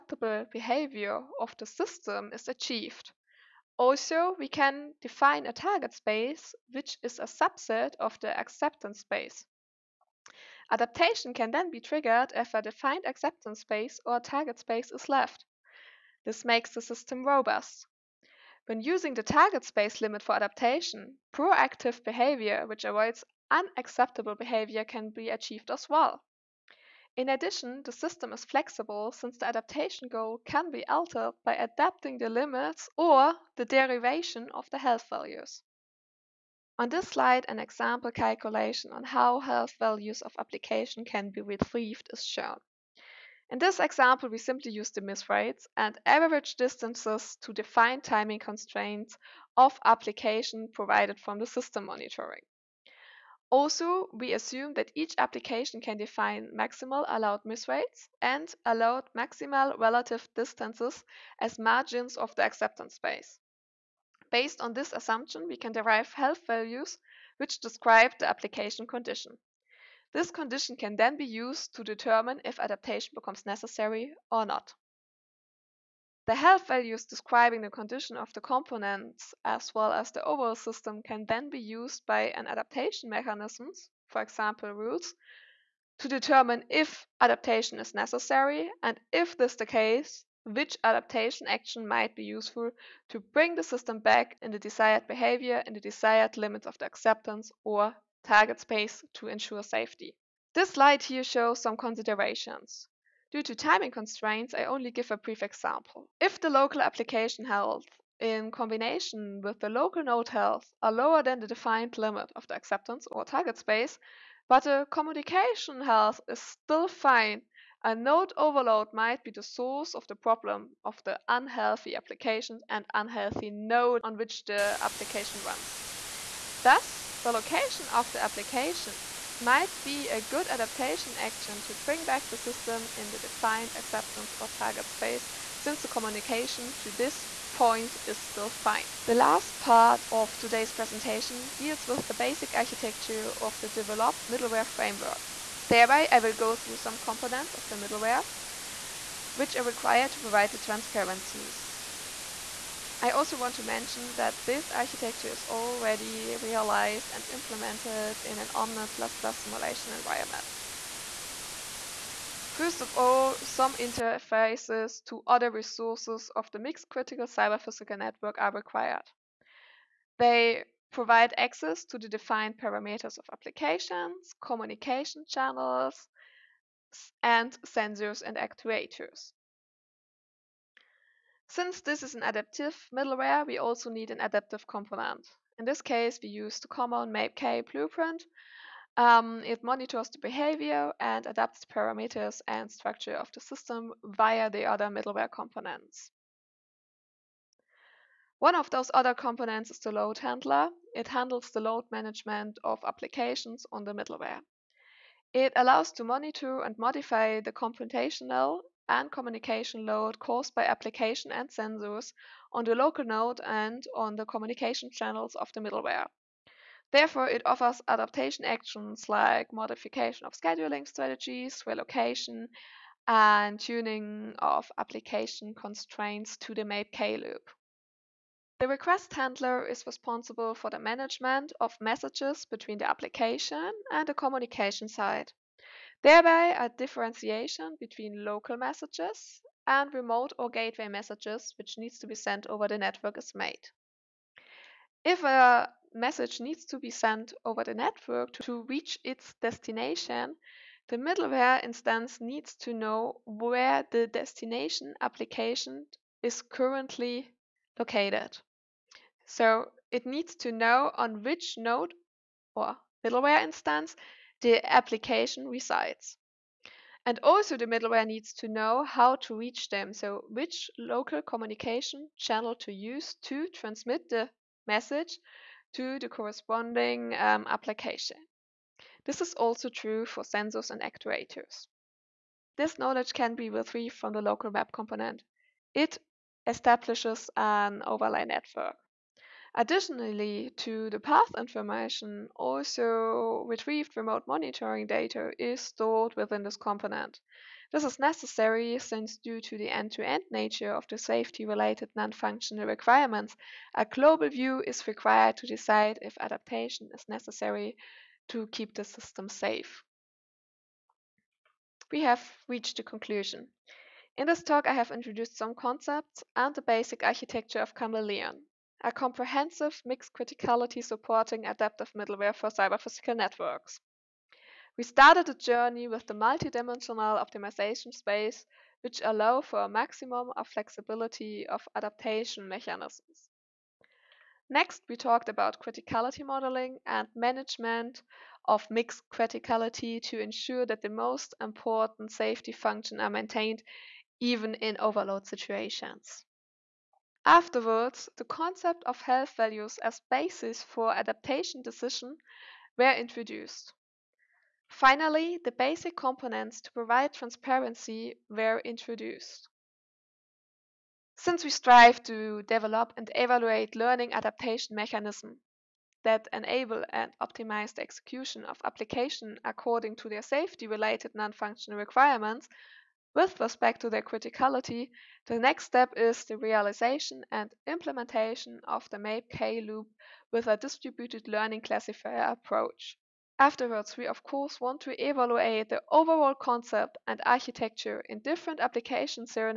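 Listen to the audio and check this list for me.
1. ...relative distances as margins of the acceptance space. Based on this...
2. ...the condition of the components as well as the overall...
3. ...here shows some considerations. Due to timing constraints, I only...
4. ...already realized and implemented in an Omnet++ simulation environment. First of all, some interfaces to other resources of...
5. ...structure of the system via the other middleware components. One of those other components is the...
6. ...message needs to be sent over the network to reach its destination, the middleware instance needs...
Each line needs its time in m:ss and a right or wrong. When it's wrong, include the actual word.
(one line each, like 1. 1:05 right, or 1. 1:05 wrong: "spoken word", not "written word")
1. 0:59 right
2. 1:17 right
3. 1:41 right
4. 2:35 right
5. 3:12 right
6. 4:05 right.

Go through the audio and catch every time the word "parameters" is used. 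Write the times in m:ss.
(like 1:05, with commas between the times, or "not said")
2:52, 3:11.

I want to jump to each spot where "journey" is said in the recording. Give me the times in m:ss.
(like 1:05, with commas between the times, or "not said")
5:25.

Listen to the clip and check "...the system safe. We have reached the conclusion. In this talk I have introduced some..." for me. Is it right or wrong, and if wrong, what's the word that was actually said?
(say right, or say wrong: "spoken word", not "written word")
right.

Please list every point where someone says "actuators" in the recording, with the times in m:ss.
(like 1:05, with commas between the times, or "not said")
2:58, 4:40.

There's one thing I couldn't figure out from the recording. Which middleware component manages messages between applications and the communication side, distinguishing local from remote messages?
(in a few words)
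Request handler.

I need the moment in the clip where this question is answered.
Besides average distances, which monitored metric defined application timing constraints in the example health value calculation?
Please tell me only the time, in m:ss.
0:45.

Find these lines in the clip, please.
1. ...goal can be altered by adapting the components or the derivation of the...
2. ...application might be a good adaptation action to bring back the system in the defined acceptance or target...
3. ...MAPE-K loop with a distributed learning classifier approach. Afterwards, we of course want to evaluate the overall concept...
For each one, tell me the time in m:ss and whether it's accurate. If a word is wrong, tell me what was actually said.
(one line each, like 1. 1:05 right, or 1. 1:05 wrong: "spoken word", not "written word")
1. 0:30 wrong: "limits", not "components"
2. 2:08 right
3. 6:18 right.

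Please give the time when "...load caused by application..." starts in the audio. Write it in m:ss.
3:29.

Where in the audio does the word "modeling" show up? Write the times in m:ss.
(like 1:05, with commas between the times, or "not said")
5:36.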